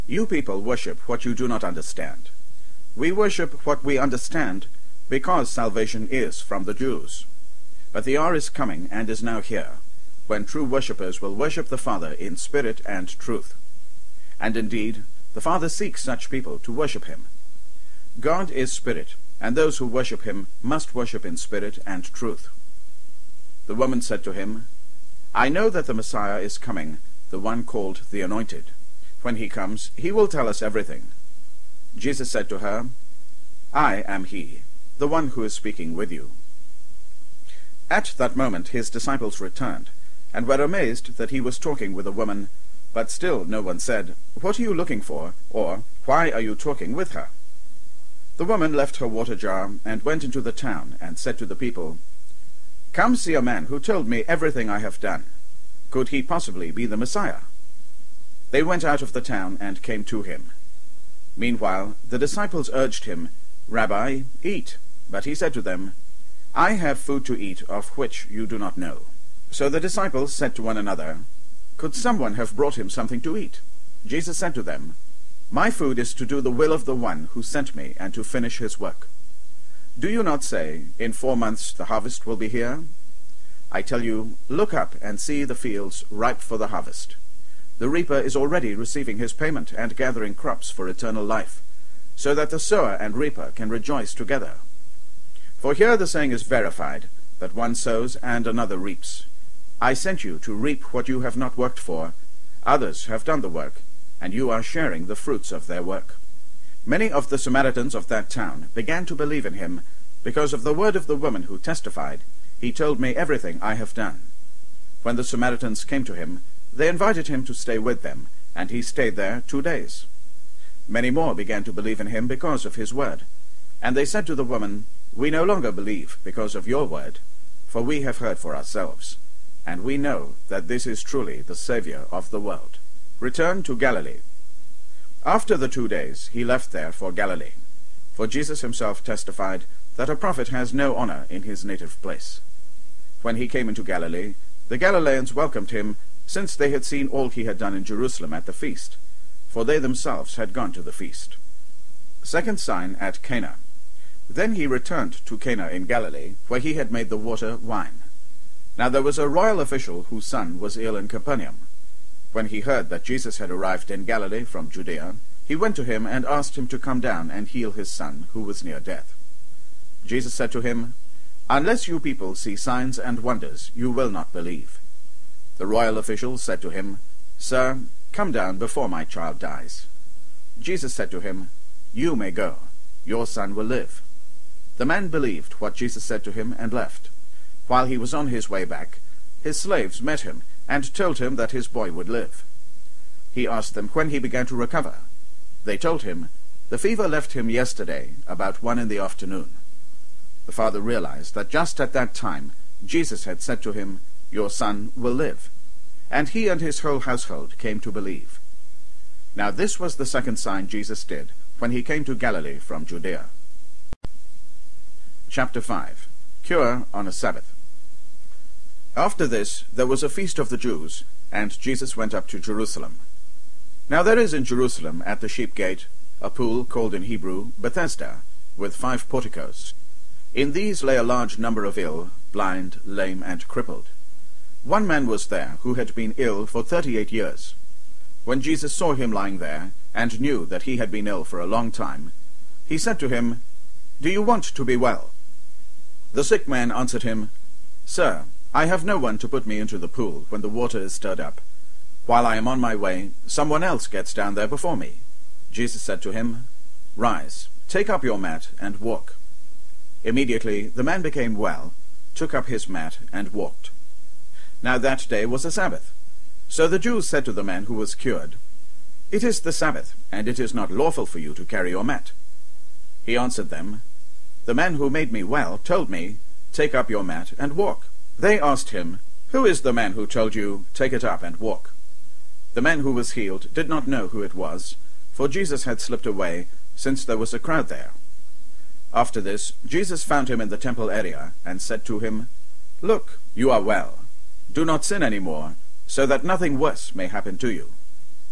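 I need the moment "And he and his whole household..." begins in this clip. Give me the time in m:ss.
3:26.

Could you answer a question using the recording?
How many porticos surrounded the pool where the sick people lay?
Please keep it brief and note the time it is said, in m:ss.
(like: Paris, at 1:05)
5, at 3:48.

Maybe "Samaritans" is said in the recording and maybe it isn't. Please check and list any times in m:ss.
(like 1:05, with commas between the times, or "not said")
1:47, 1:55.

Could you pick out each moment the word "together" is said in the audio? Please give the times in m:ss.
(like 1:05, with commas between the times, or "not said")
1:34.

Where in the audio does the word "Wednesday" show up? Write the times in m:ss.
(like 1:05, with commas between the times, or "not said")
not said.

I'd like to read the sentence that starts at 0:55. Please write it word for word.
Could he possibly be the Messiah?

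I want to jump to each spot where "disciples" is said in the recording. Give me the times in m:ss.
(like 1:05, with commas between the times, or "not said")
0:38, 1:02, 1:09.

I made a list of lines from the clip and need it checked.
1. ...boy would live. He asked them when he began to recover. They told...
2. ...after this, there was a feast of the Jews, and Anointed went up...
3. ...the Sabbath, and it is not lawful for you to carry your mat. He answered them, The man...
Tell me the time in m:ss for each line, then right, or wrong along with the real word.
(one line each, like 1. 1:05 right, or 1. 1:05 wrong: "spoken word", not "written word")
1. 3:11 right
2. 3:38 wrong: "Jesus", not "Anointed"
3. 4:29 right.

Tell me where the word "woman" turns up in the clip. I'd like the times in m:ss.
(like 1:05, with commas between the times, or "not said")
0:23, 0:42, 0:48, 1:51, 2:04.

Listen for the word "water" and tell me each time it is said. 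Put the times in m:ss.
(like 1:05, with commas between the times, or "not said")
0:49, 2:37, 4:10.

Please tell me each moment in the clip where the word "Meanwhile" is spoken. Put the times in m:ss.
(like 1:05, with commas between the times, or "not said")
1:01.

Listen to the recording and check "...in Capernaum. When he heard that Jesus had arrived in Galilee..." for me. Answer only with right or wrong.
right.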